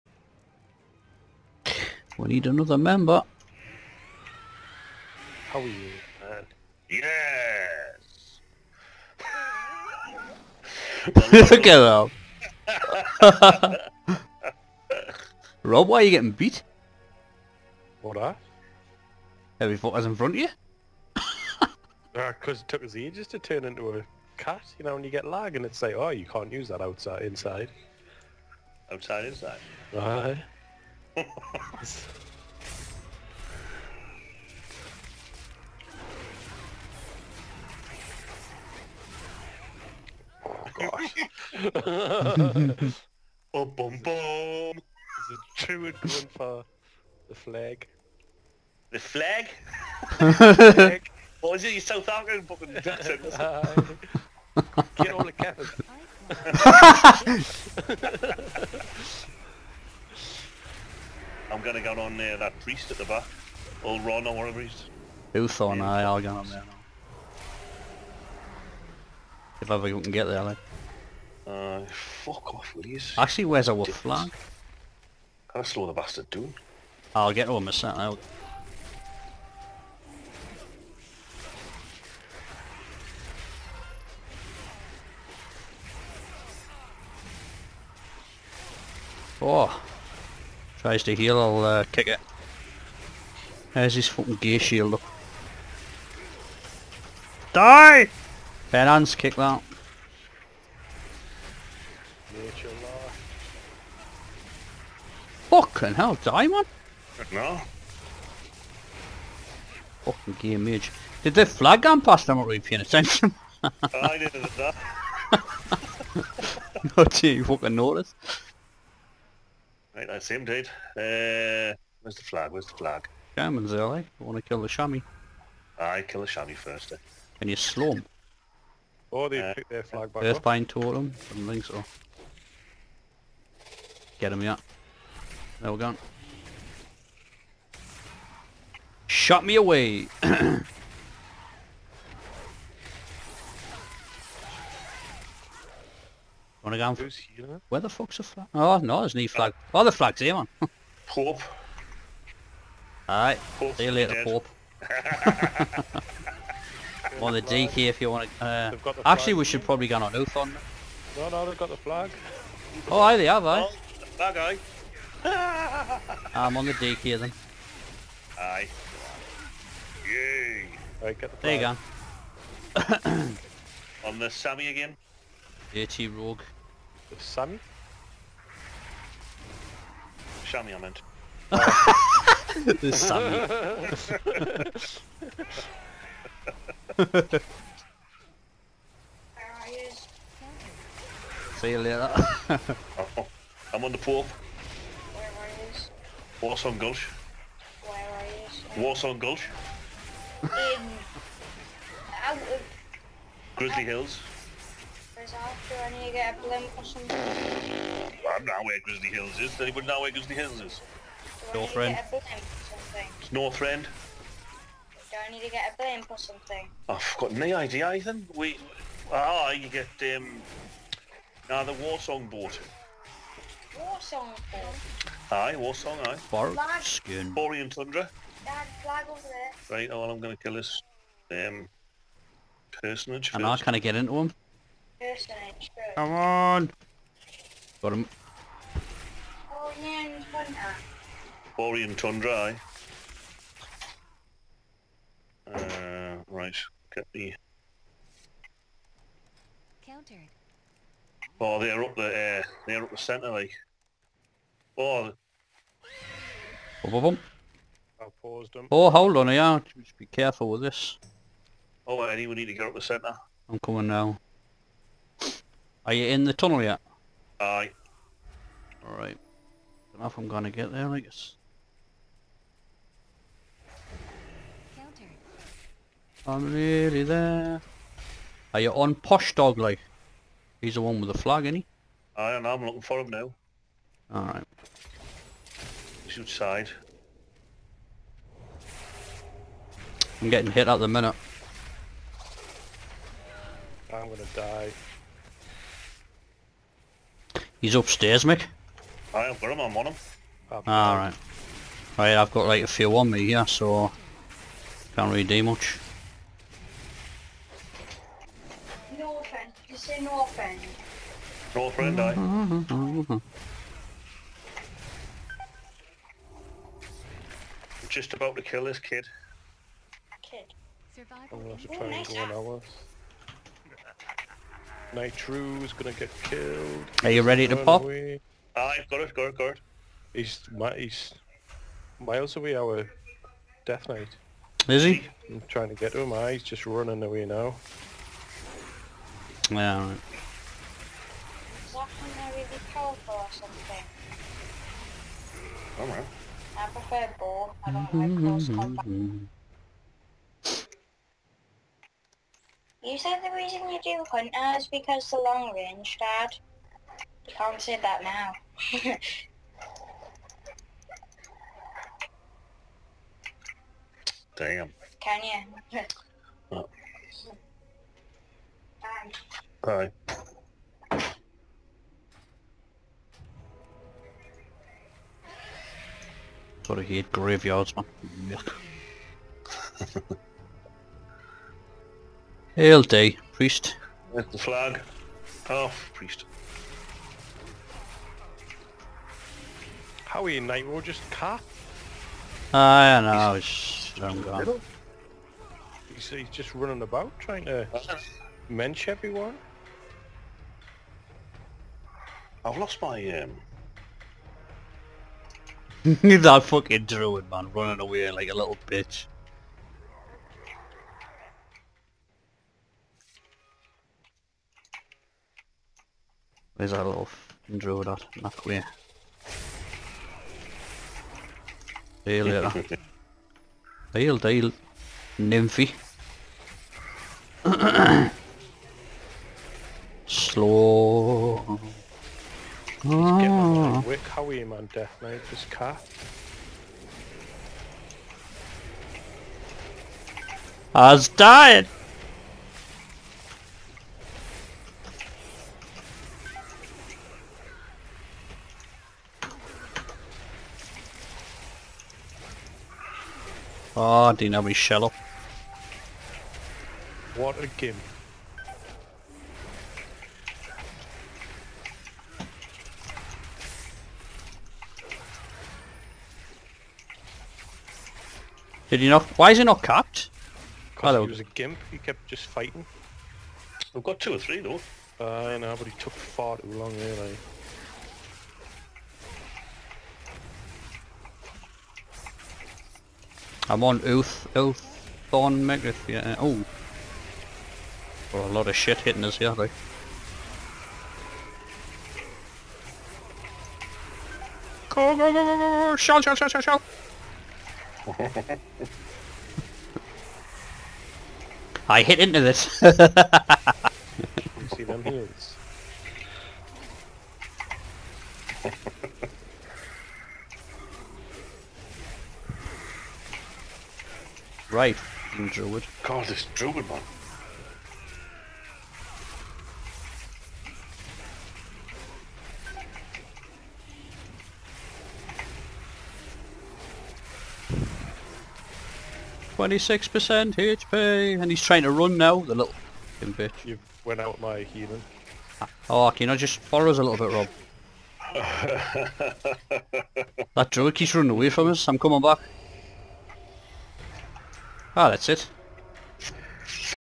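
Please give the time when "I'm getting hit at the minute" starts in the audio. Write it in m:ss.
4:50.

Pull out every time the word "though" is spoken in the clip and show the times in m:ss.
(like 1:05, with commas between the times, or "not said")
7:54, 8:09.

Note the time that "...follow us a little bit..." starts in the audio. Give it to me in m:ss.
8:56.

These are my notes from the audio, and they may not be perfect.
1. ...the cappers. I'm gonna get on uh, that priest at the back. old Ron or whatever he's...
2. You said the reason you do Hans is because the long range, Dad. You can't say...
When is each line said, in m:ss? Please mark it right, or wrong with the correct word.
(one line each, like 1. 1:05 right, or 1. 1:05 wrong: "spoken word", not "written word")
1. 0:55 right
2. 5:52 wrong: "Hunter", not "Hans".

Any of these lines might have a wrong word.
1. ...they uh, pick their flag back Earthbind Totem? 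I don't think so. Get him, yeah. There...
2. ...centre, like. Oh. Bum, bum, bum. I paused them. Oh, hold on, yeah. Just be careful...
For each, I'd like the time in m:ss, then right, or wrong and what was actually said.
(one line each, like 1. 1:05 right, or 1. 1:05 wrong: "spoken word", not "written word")
1. 2:09 right
2. 4:12 right.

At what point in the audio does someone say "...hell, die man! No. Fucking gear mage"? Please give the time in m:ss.
1:45.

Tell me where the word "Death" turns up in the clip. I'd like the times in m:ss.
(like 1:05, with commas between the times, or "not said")
5:33, 7:14.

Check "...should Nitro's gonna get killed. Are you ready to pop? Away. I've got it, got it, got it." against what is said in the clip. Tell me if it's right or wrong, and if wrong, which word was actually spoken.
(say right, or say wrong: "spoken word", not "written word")
right.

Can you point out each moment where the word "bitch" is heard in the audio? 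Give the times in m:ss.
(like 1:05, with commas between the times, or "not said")
6:48, 8:52.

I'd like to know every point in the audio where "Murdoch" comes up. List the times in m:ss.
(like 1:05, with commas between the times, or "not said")
not said.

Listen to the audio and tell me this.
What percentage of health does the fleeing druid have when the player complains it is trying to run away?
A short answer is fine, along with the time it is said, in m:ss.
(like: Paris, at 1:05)
26%, at 8:49.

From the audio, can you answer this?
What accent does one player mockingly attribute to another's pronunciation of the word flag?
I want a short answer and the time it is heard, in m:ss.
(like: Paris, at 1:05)
South African, at 0:51.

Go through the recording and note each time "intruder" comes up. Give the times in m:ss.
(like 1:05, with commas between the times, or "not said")
6:57.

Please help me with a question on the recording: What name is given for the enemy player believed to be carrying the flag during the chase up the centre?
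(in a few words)
Posh Dog.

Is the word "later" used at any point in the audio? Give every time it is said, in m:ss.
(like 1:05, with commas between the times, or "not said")
2:33, 3:11, 7:02.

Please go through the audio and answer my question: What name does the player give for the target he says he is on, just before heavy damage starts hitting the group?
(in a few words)
Oaththorn Megrith.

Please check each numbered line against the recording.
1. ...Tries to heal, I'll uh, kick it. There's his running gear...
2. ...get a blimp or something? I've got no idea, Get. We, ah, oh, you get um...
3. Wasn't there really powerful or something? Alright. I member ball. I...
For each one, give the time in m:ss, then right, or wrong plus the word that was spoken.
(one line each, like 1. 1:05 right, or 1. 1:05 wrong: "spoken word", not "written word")
1. 1:30 wrong: "fucking", not "running"
2. 3:35 wrong: "Ethan", not "Get"
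3. 5:41 wrong: "prefer", not "member".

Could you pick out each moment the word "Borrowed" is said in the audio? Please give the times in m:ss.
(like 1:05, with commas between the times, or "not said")
3:46.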